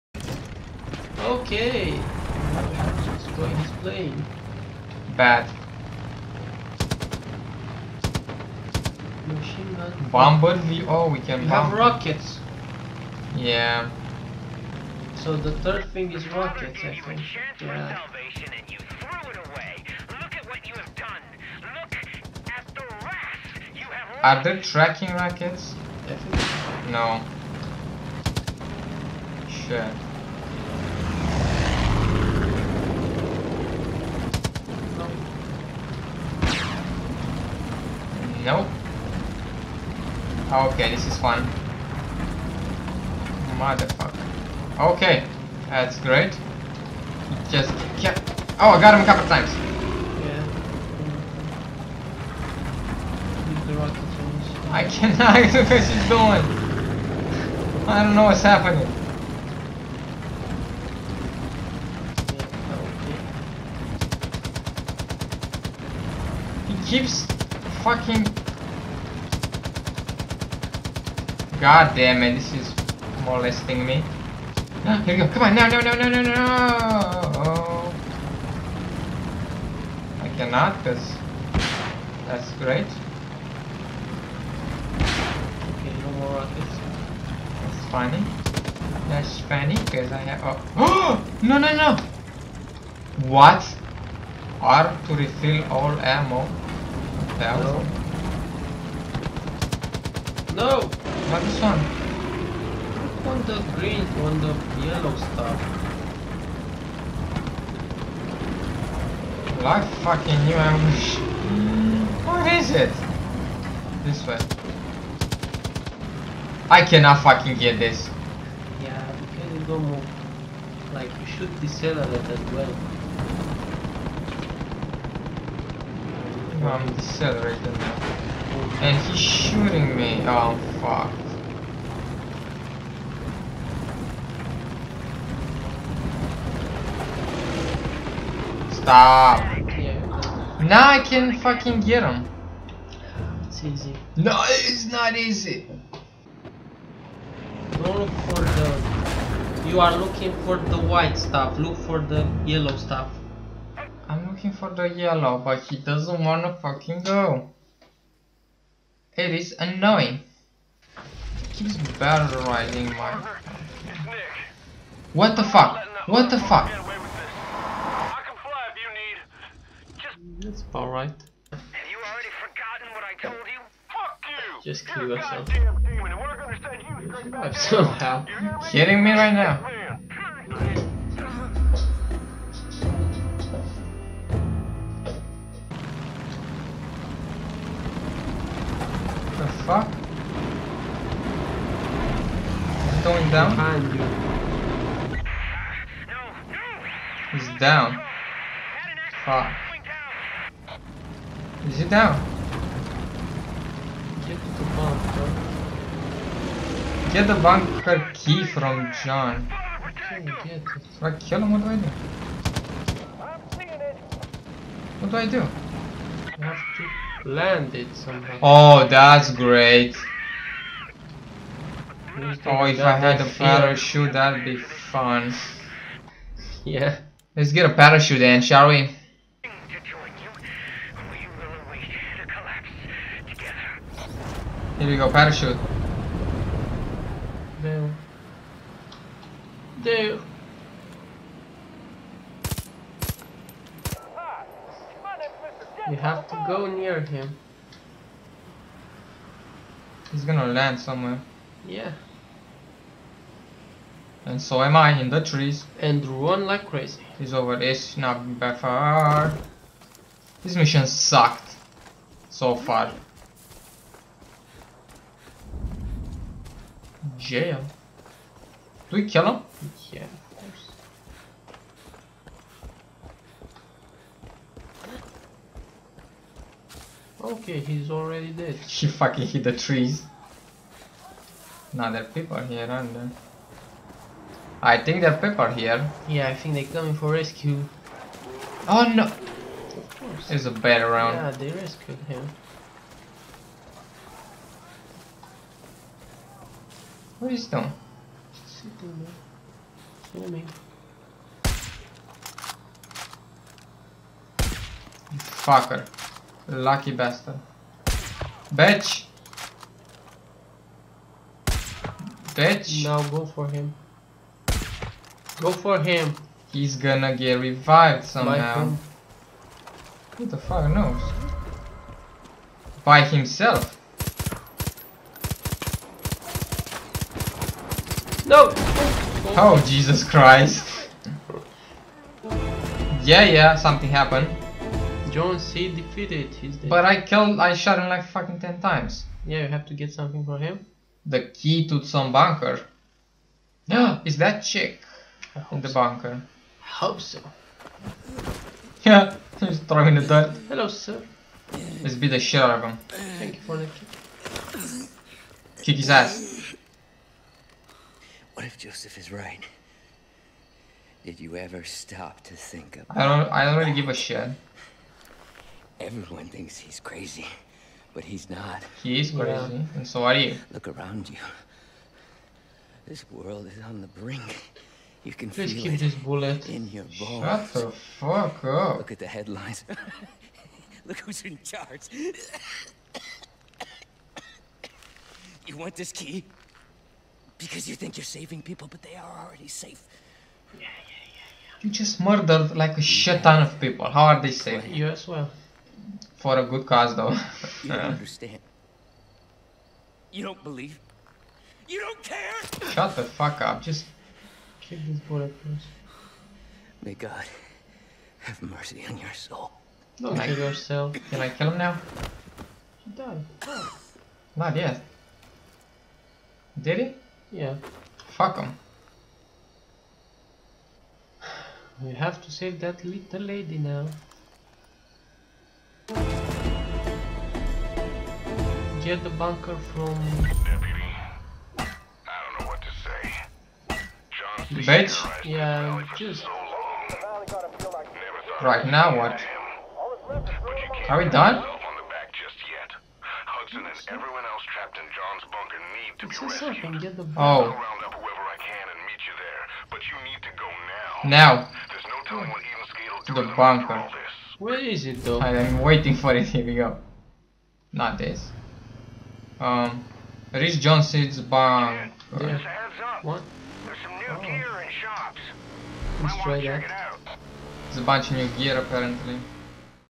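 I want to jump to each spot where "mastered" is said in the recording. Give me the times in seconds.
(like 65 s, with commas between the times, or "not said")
not said.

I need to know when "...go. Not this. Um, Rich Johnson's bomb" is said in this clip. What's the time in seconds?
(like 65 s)
456 s.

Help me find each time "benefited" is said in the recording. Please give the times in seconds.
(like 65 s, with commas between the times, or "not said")
not said.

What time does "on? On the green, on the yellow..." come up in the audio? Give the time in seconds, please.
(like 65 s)
101 s.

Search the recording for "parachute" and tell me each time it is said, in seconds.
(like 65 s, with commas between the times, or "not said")
223 s, 227 s, 235 s.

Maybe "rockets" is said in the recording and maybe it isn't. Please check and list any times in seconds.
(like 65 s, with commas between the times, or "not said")
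11 s, 16 s, 25 s, 86 s.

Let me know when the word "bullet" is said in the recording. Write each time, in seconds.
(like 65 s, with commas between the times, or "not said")
375 s, 405 s.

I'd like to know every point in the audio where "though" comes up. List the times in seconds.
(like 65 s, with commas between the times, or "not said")
396 s, 455 s.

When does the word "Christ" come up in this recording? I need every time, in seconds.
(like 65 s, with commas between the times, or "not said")
330 s.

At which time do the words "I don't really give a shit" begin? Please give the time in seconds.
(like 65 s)
363 s.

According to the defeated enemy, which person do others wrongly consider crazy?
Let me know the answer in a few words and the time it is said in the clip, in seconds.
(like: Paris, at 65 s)
Joseph, at 358 s.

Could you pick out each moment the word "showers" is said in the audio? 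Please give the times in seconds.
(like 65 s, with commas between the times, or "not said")
not said.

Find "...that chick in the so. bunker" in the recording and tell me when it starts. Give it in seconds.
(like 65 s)
344 s.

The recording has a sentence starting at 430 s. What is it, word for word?
Deputy, I don't know what to say.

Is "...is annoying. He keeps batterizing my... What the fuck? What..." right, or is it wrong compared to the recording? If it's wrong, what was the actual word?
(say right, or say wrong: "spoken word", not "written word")
right.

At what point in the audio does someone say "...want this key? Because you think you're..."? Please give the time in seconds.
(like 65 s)
385 s.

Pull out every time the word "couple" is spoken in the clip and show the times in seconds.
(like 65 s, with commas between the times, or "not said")
49 s.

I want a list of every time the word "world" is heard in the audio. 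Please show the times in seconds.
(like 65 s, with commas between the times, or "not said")
373 s.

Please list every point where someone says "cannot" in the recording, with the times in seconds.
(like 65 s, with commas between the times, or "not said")
54 s, 80 s, 116 s.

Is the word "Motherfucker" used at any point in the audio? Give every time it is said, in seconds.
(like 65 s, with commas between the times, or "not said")
43 s.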